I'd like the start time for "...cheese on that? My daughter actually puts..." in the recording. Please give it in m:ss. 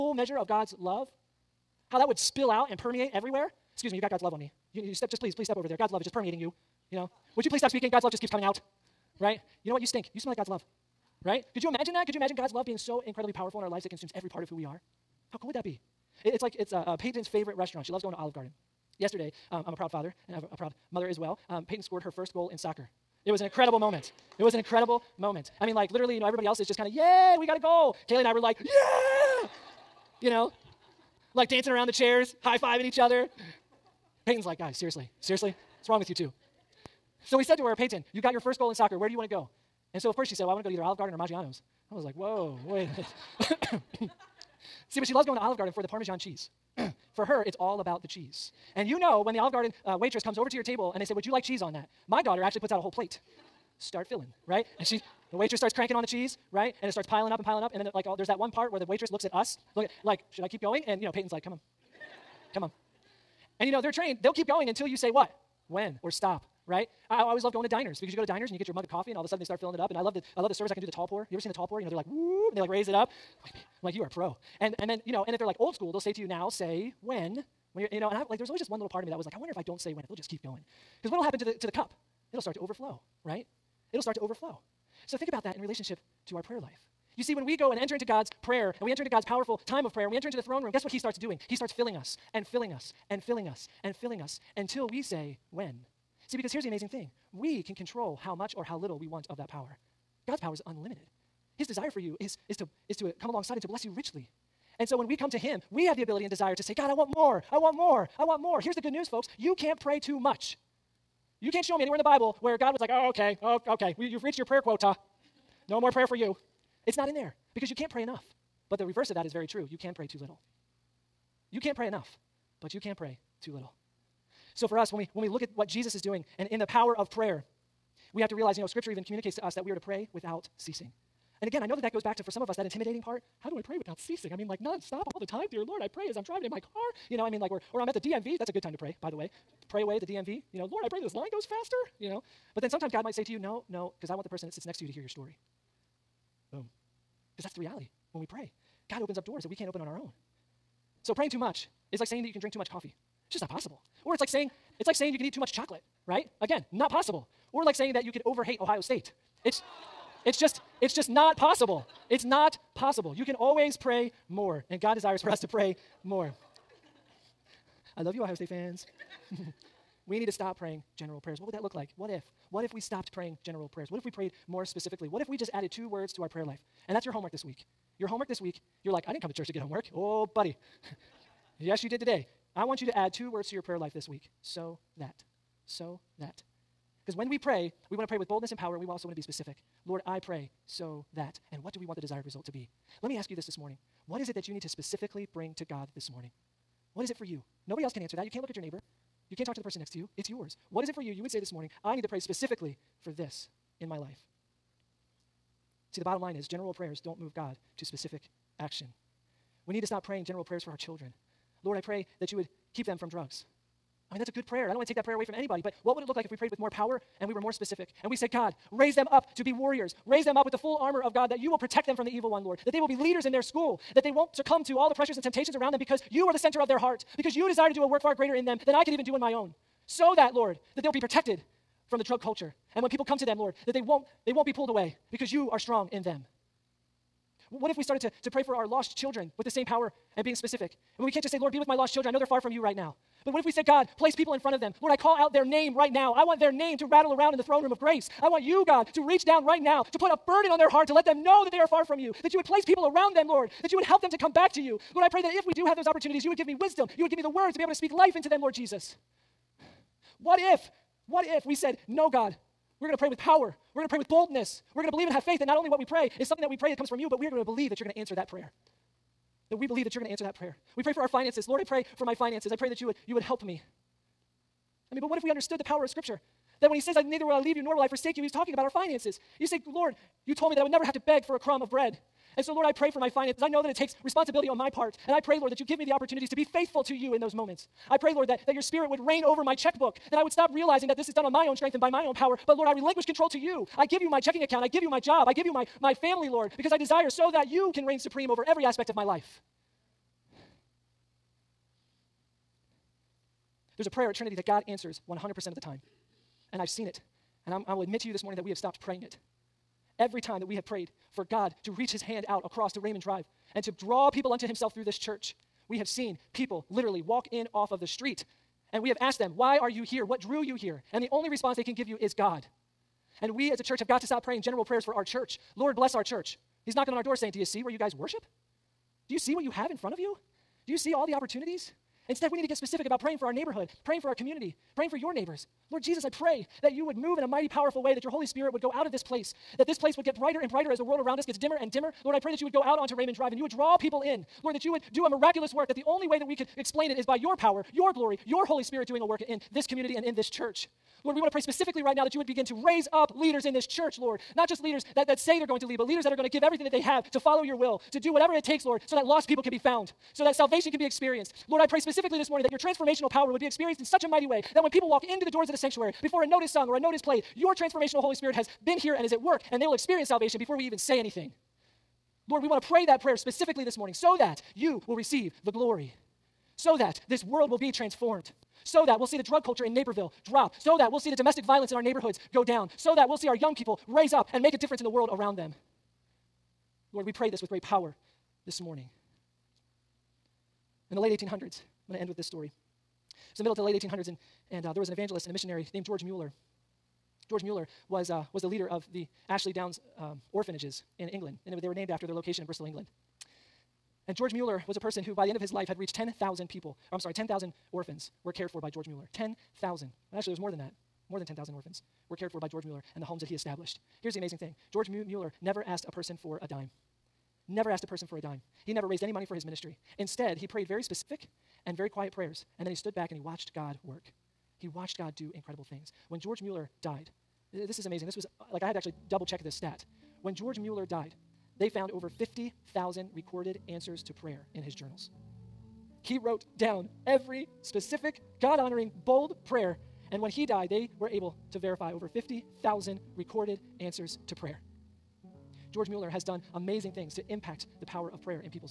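0:51.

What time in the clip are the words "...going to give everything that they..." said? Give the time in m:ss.
5:56.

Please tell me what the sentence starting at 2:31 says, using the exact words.
So praying too much is like saying that you can drink too much coffee.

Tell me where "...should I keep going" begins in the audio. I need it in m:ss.
1:00.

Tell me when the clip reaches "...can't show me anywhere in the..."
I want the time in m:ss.
1:51.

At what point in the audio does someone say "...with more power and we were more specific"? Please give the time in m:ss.
3:36.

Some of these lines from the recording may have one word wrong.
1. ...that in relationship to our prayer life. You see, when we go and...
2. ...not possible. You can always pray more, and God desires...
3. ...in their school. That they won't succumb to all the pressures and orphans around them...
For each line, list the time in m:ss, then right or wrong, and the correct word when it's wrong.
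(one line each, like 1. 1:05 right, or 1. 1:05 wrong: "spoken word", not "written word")
1. 1:25 right
2. 2:42 right
3. 3:43 wrong: "temptations", not "orphans".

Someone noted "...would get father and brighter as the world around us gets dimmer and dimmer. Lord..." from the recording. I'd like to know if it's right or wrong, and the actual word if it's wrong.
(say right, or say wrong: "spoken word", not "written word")
wrong: "brighter", not "father".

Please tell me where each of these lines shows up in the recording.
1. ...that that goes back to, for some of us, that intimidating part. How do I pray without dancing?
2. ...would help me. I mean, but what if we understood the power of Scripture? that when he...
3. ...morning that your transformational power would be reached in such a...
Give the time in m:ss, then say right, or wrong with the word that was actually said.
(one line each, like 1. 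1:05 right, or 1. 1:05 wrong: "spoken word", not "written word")
1. 2:11 wrong: "ceasing", not "dancing"
2. 4:33 right
3. 6:02 wrong: "experienced", not "reached".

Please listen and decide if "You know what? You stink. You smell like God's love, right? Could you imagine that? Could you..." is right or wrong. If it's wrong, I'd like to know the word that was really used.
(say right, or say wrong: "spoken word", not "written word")
right.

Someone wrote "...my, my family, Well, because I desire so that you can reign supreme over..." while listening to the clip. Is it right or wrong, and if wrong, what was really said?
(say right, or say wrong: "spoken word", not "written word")
wrong: "Lord", not "Well".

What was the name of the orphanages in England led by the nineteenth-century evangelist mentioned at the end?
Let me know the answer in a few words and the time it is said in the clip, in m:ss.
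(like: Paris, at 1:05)
Ashley Downs, at 6:39.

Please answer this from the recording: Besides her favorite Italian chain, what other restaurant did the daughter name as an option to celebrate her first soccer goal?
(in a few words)
Maggiano's.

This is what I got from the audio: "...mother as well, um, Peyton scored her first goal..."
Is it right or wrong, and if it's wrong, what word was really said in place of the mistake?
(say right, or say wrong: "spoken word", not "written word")
right.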